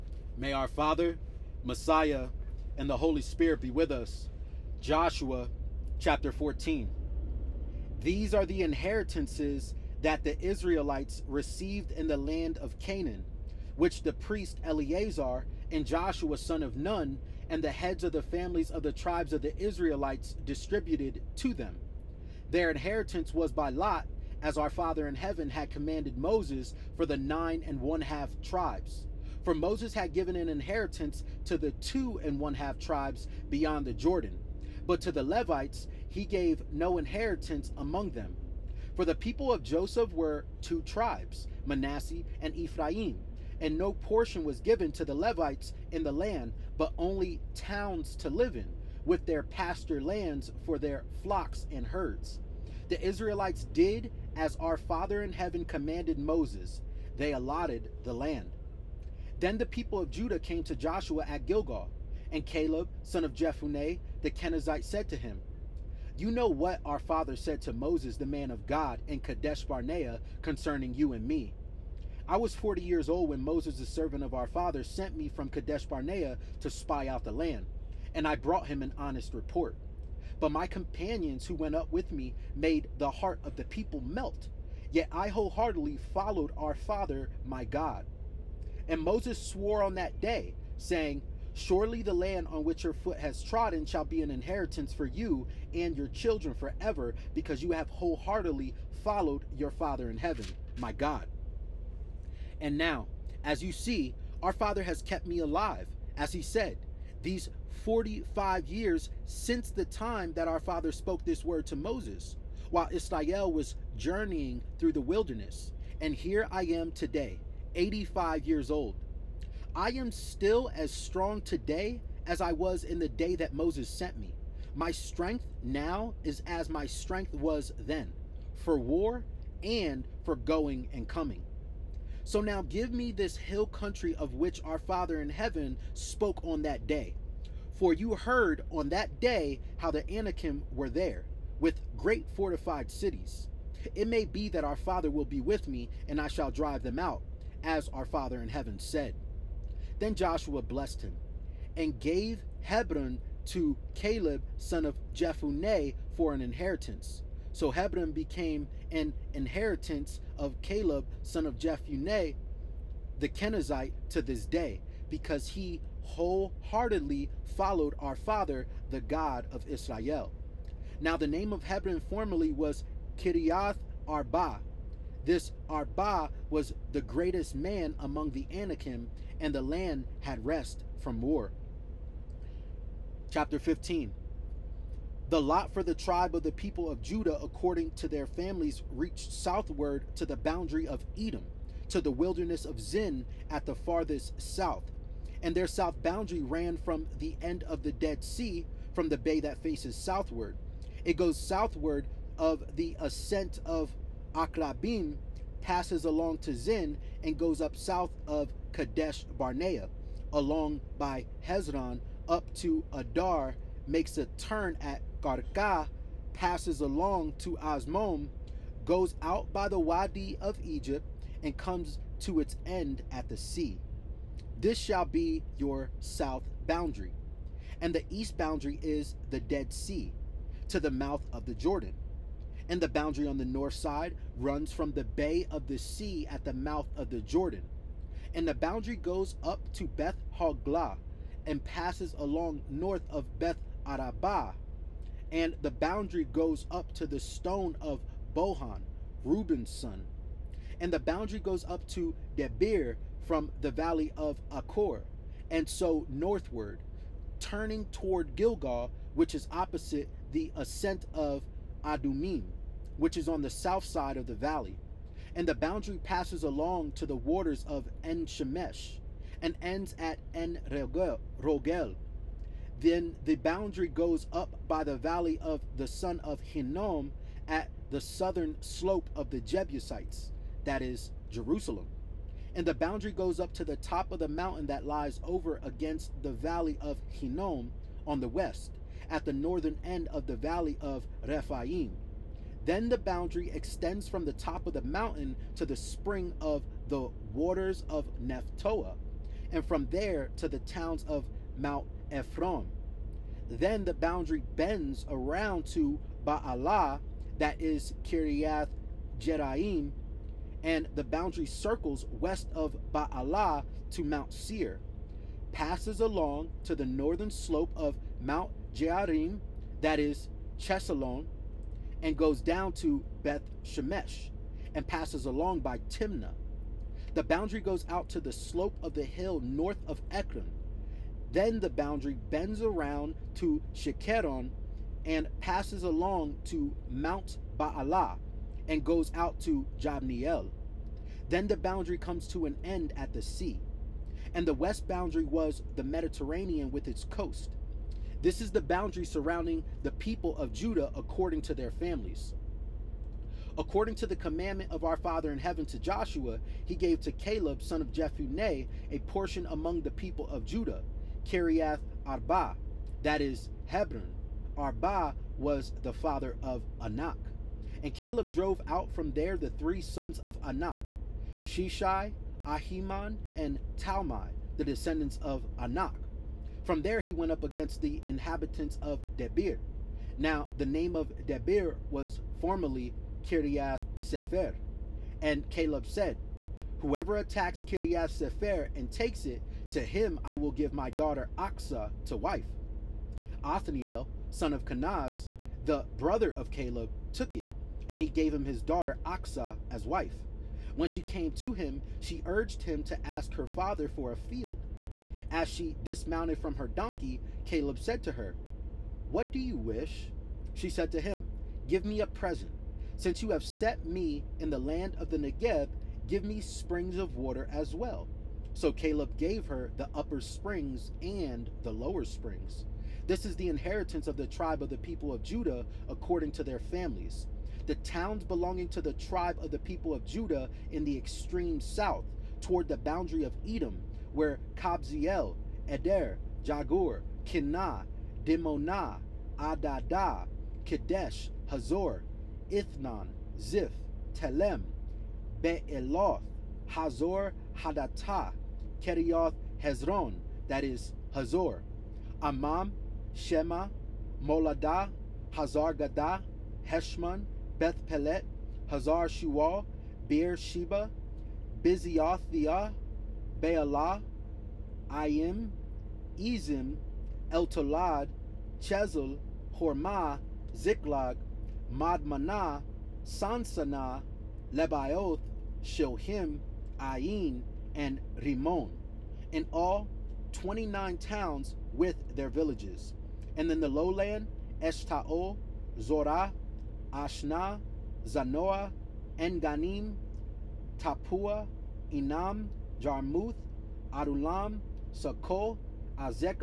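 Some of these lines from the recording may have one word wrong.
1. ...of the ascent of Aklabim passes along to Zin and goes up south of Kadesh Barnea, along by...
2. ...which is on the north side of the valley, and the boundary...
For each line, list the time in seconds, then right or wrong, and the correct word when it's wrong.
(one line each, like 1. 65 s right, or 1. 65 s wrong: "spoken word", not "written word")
1. 202 s right
2. 262 s wrong: "south", not "north".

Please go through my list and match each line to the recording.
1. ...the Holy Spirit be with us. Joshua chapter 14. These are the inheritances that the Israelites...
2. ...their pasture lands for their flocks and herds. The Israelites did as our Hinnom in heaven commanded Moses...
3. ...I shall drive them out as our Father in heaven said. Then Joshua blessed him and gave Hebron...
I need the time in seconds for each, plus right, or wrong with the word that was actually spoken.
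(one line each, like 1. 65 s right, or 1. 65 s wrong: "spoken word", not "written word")
1. 2 s right
2. 49 s wrong: "Father", not "Hinnom"
3. 146 s right.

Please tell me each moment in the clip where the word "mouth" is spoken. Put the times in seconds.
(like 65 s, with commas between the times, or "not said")
230 s, 236 s.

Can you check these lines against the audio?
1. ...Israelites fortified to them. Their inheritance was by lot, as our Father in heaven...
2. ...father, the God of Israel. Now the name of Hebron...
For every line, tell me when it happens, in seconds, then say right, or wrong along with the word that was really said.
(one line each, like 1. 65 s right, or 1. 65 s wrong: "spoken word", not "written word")
1. 19 s wrong: "distributed", not "fortified"
2. 168 s right.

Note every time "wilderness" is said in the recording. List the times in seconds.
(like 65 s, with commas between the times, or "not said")
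115 s, 192 s.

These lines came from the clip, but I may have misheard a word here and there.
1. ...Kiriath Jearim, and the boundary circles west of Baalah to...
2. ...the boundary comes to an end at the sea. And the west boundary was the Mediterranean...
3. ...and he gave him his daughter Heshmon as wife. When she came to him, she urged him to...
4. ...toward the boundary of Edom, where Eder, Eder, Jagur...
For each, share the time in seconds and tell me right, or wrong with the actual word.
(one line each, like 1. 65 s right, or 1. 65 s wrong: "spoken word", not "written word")
1. 308 s right
2. 341 s right
3. 397 s wrong: "Achsah", not "Heshmon"
4. 432 s wrong: "Kabzeel", not "Eder".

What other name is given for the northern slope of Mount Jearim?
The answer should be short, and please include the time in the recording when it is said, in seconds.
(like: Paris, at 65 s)
Chesalon, at 320 s.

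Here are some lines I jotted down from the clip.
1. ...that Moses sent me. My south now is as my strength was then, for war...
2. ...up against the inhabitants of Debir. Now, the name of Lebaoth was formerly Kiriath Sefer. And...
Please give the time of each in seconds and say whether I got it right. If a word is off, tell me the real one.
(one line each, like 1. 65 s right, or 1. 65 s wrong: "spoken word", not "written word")
1. 123 s wrong: "strength", not "south"
2. 377 s wrong: "Debir", not "Lebaoth".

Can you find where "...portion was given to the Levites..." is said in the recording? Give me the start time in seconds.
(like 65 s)
43 s.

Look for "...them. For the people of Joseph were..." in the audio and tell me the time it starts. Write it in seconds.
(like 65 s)
38 s.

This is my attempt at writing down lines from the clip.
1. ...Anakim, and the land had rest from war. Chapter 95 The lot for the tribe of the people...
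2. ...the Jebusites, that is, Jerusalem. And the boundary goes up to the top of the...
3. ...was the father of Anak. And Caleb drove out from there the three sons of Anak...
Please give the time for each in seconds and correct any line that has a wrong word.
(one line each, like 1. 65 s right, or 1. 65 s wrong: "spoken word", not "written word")
1. 178 s wrong: "15", not "95"
2. 279 s right
3. 365 s right.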